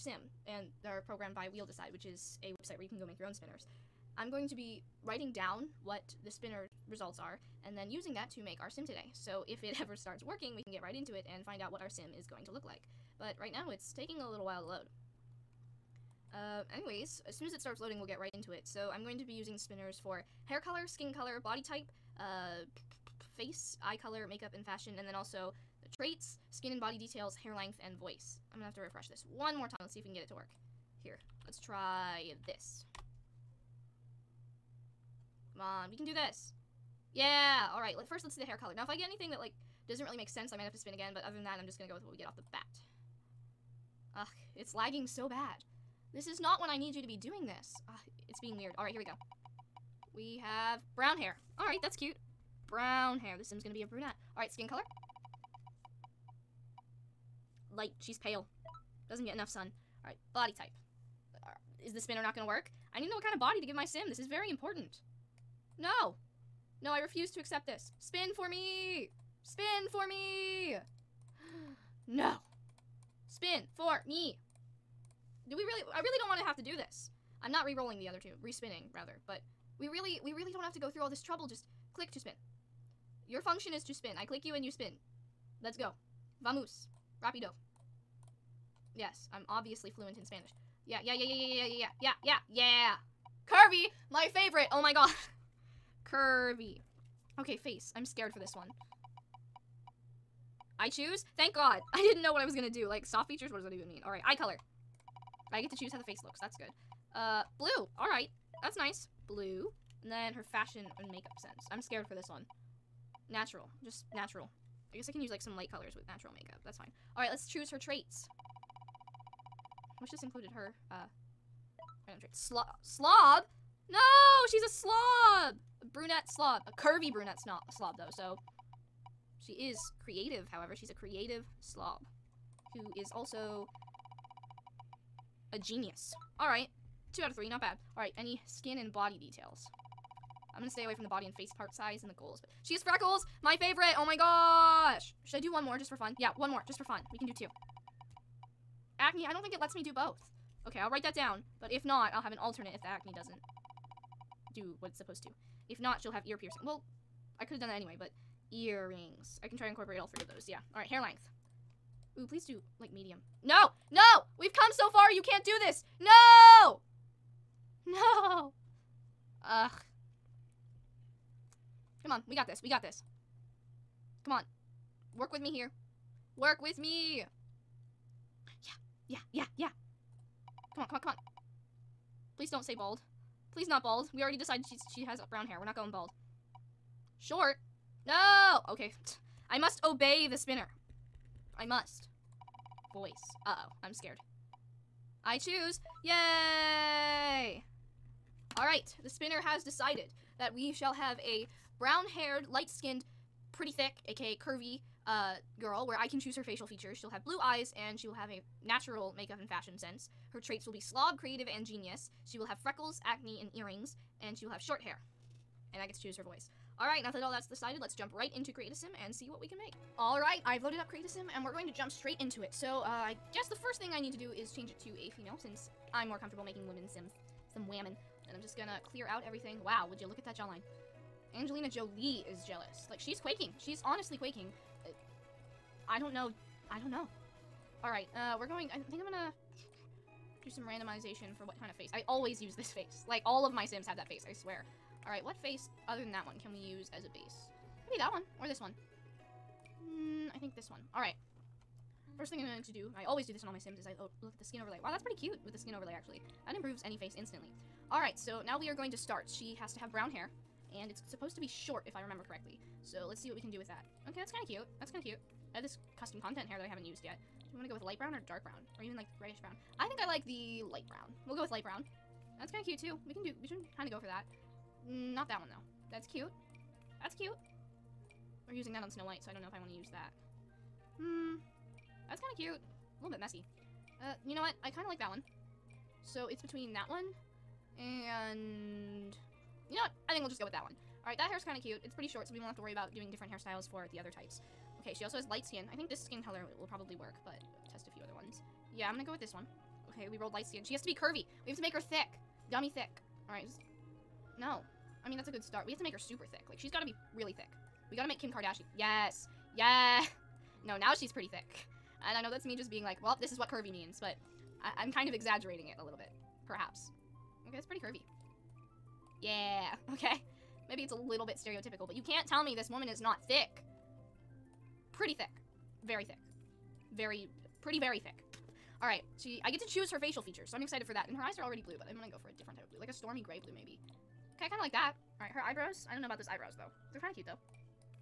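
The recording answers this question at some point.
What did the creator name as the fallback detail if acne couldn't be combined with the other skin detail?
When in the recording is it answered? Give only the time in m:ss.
2:36.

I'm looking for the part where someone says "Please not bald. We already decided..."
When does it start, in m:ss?
3:03.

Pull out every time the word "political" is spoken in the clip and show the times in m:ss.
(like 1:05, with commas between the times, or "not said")
not said.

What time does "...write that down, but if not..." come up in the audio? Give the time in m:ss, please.
2:30.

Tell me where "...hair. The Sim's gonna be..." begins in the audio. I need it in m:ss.
0:53.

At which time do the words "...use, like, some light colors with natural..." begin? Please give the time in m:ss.
1:55.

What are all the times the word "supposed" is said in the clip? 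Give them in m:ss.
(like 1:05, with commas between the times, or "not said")
2:34, 4:21.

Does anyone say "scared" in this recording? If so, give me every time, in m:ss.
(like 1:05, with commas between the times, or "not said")
1:38, 1:51, 3:13.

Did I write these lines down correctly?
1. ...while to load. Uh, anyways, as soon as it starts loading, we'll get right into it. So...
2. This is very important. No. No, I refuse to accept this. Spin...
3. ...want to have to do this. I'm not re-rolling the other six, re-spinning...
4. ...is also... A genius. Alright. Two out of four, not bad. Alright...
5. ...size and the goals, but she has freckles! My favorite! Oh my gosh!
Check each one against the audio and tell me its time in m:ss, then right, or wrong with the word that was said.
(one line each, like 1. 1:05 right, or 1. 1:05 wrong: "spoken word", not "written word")
1. 0:14 right
2. 1:04 right
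3. 1:16 wrong: "two", not "six"
4. 2:12 wrong: "three", not "four"
5. 2:21 right.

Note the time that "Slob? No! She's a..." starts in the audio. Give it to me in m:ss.
2:02.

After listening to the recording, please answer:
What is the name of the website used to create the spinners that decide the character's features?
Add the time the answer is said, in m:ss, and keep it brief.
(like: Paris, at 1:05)
Wheel Decide, at 0:01.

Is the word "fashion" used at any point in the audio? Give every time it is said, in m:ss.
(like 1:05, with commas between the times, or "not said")
0:24, 1:50, 3:29.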